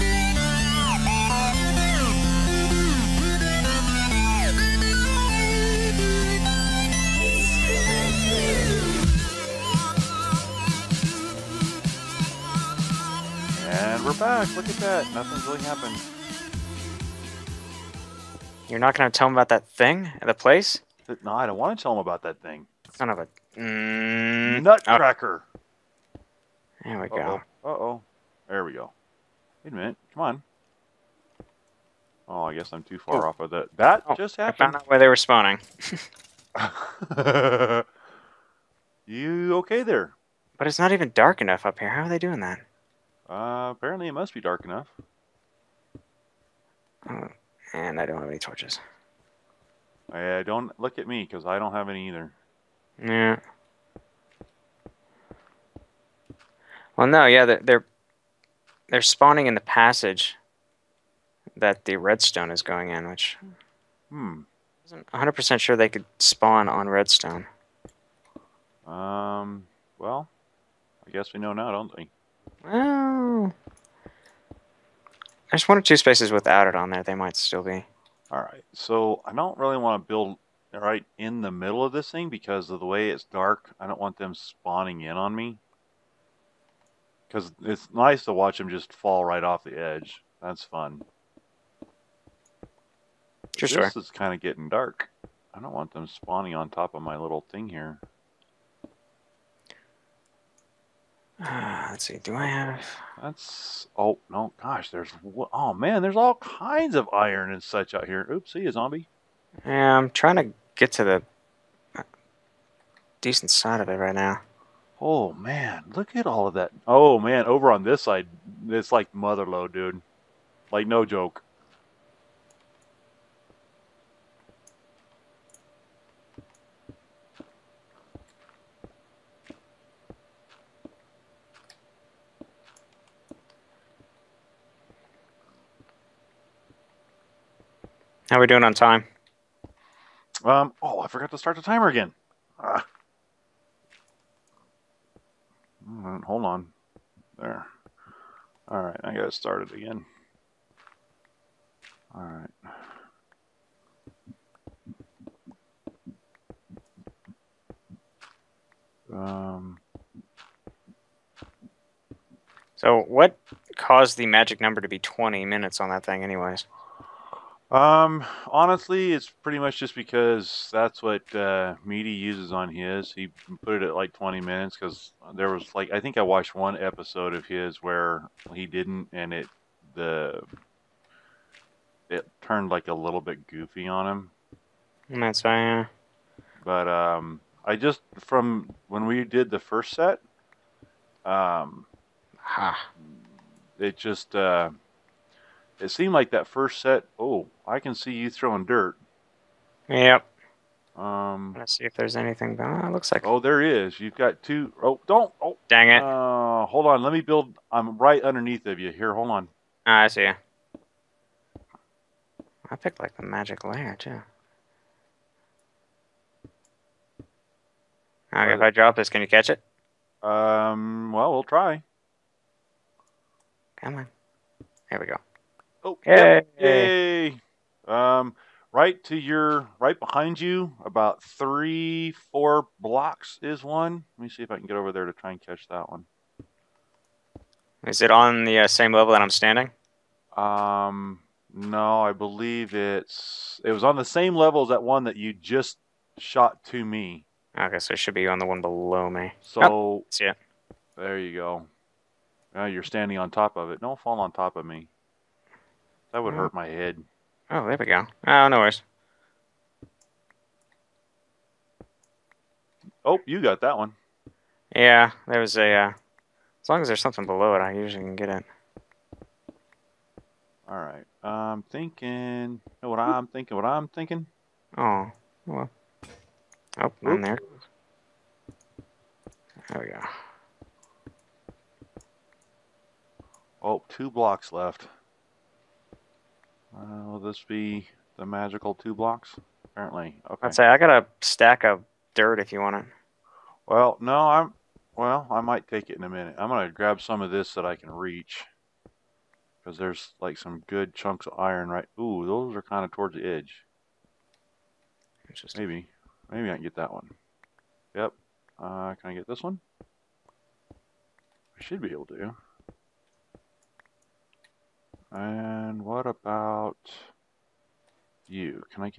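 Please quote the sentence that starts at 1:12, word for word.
Well, there's one or two spaces without it on there.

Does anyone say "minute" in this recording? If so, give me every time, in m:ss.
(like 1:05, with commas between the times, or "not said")
0:29, 2:45, 2:54, 4:56.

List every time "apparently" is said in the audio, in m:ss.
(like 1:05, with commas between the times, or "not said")
0:43, 4:49.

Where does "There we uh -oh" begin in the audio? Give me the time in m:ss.
0:26.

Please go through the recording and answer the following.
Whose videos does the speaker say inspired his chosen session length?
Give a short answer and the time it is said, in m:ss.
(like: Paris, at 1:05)
Meaty, at 2:51.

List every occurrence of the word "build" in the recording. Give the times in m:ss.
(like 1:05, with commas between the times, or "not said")
1:20, 3:27.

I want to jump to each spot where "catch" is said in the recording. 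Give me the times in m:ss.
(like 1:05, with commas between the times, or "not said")
3:39, 3:55.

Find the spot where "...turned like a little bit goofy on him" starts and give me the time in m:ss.
3:02.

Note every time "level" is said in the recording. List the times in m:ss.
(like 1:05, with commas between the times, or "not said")
3:58, 4:04.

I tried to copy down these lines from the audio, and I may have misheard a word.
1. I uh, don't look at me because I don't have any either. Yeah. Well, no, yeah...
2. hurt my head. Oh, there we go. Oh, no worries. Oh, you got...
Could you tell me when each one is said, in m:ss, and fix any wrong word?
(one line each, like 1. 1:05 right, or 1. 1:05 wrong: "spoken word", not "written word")
1. 0:50 right
2. 4:16 right.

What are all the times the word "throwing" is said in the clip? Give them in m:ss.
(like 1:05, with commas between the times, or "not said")
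3:18.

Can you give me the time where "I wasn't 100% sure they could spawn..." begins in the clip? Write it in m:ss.
1:04.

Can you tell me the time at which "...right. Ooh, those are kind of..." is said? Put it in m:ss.
5:01.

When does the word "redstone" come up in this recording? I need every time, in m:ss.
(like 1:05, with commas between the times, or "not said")
1:01, 1:06.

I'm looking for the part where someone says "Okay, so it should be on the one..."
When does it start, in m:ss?
4:07.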